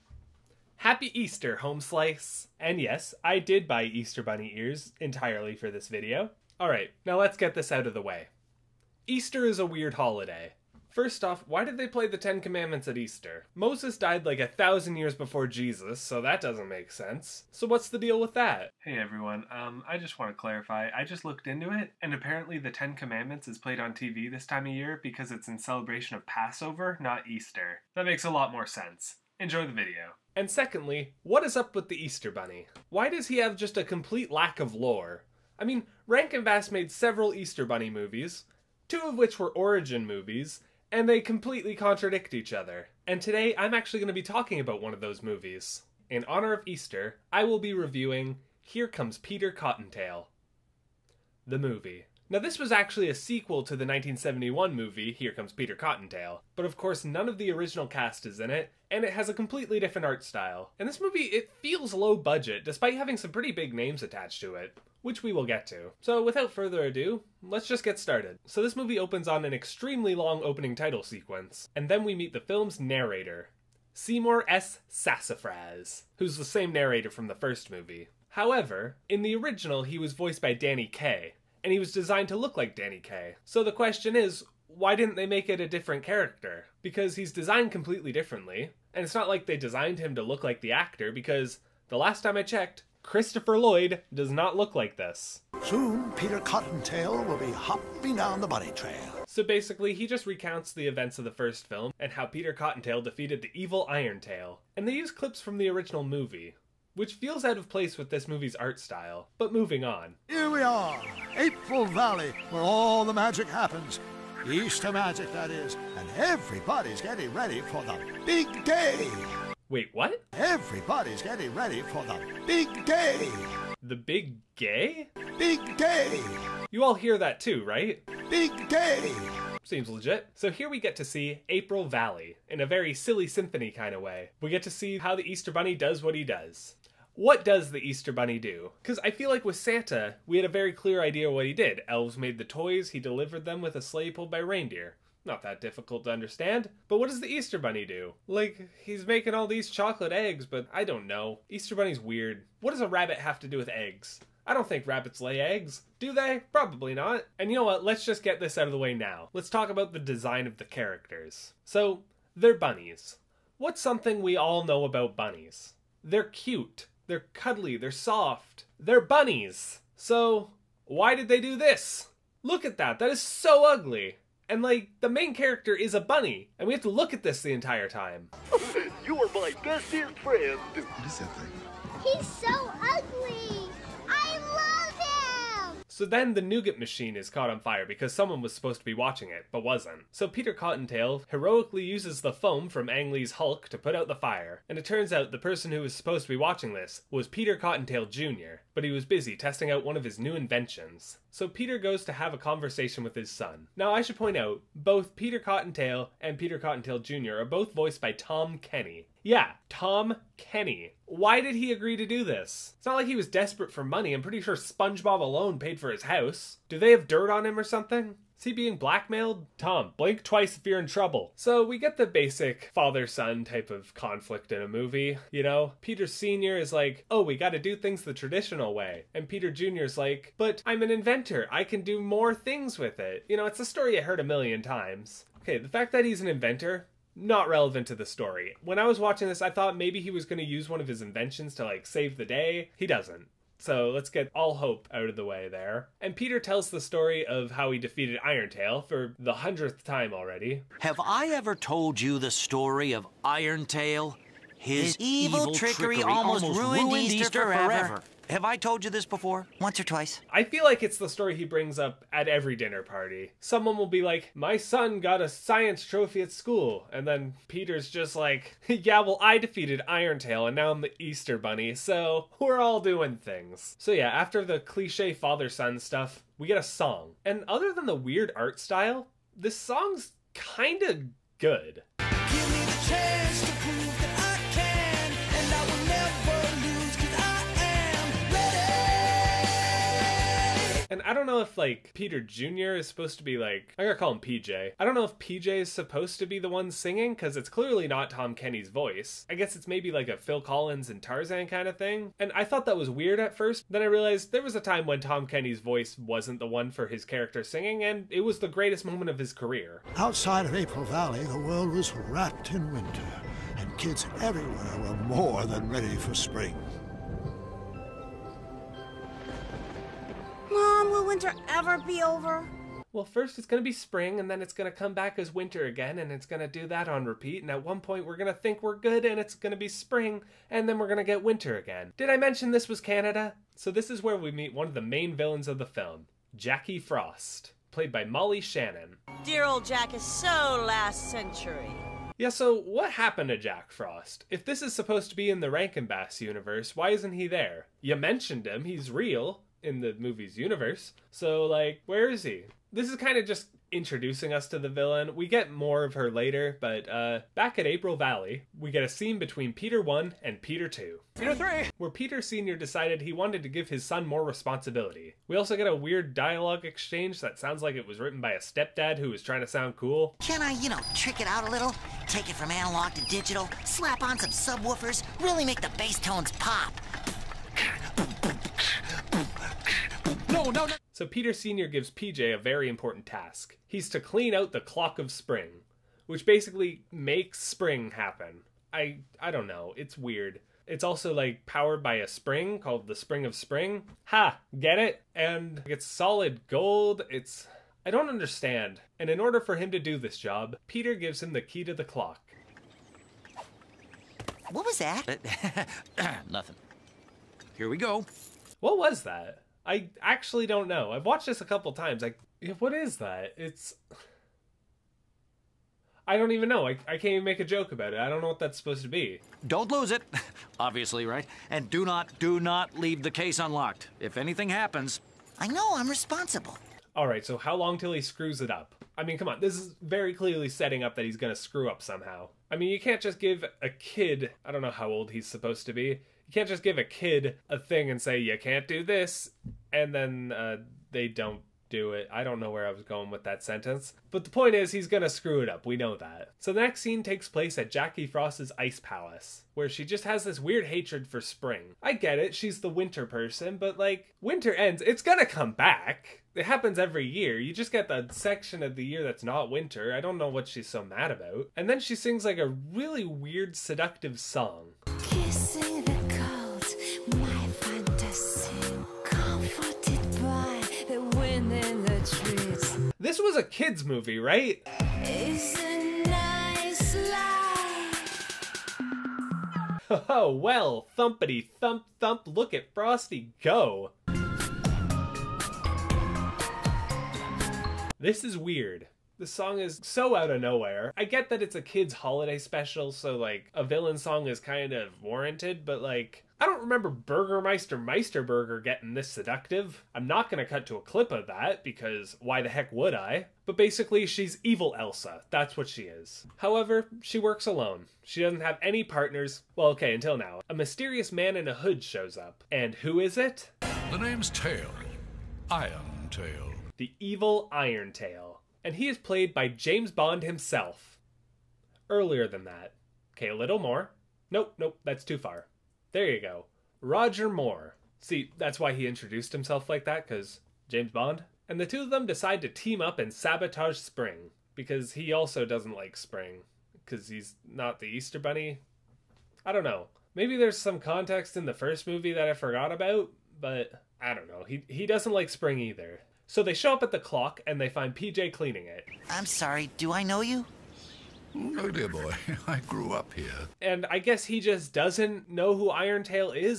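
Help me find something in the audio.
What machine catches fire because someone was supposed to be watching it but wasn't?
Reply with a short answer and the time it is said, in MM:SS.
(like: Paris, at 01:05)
nougat machine, at 03:06.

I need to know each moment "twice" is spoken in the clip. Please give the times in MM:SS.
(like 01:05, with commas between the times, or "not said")
03:40, 04:19.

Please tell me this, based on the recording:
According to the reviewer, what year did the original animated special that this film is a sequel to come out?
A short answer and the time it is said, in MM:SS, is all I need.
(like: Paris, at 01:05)
1971, at 00:53.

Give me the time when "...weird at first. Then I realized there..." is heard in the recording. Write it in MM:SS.
05:02.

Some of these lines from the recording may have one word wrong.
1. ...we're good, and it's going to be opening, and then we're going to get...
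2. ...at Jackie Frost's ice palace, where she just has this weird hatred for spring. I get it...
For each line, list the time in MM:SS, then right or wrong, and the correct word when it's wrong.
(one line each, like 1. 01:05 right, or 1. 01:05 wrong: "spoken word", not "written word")
1. 05:28 wrong: "spring", not "opening"
2. 07:27 right.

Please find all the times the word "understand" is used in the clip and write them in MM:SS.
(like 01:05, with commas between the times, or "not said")
02:26, 06:38.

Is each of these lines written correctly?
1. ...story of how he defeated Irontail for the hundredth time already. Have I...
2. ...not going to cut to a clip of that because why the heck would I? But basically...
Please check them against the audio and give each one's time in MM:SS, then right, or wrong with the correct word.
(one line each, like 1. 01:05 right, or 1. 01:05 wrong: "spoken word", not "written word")
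1. 04:06 right
2. 08:20 right.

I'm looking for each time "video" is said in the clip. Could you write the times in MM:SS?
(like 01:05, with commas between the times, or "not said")
00:05, 00:29.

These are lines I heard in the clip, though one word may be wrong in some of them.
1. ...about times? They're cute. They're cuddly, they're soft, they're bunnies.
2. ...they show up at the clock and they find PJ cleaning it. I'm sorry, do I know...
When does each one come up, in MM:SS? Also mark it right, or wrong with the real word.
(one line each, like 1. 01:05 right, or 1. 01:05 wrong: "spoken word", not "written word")
1. 02:44 wrong: "bunnies", not "times"
2. 09:06 right.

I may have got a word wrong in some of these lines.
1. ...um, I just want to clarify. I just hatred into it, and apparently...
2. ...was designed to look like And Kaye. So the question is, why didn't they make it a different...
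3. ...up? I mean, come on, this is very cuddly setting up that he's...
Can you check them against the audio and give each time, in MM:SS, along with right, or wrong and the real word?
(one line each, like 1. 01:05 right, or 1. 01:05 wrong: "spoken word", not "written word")
1. 00:19 wrong: "looked", not "hatred"
2. 01:21 wrong: "Danny", not "And"
3. 07:08 wrong: "clearly", not "cuddly".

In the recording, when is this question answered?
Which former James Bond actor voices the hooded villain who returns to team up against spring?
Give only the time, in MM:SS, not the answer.
08:46.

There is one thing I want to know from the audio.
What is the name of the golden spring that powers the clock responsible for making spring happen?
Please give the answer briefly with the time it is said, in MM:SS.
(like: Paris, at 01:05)
Spring of Spring, at 06:32.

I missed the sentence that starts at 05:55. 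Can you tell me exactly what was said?
We get more of her later, but uh, back at April Valley, we get a scene between Peter 1 and Peter 2.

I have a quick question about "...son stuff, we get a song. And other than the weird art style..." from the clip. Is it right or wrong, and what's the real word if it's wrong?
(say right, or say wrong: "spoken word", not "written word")
right.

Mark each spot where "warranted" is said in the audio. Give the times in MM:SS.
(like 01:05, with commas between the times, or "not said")
08:15.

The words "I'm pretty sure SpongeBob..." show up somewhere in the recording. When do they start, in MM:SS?
03:34.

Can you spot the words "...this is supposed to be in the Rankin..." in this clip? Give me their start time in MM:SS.
05:44.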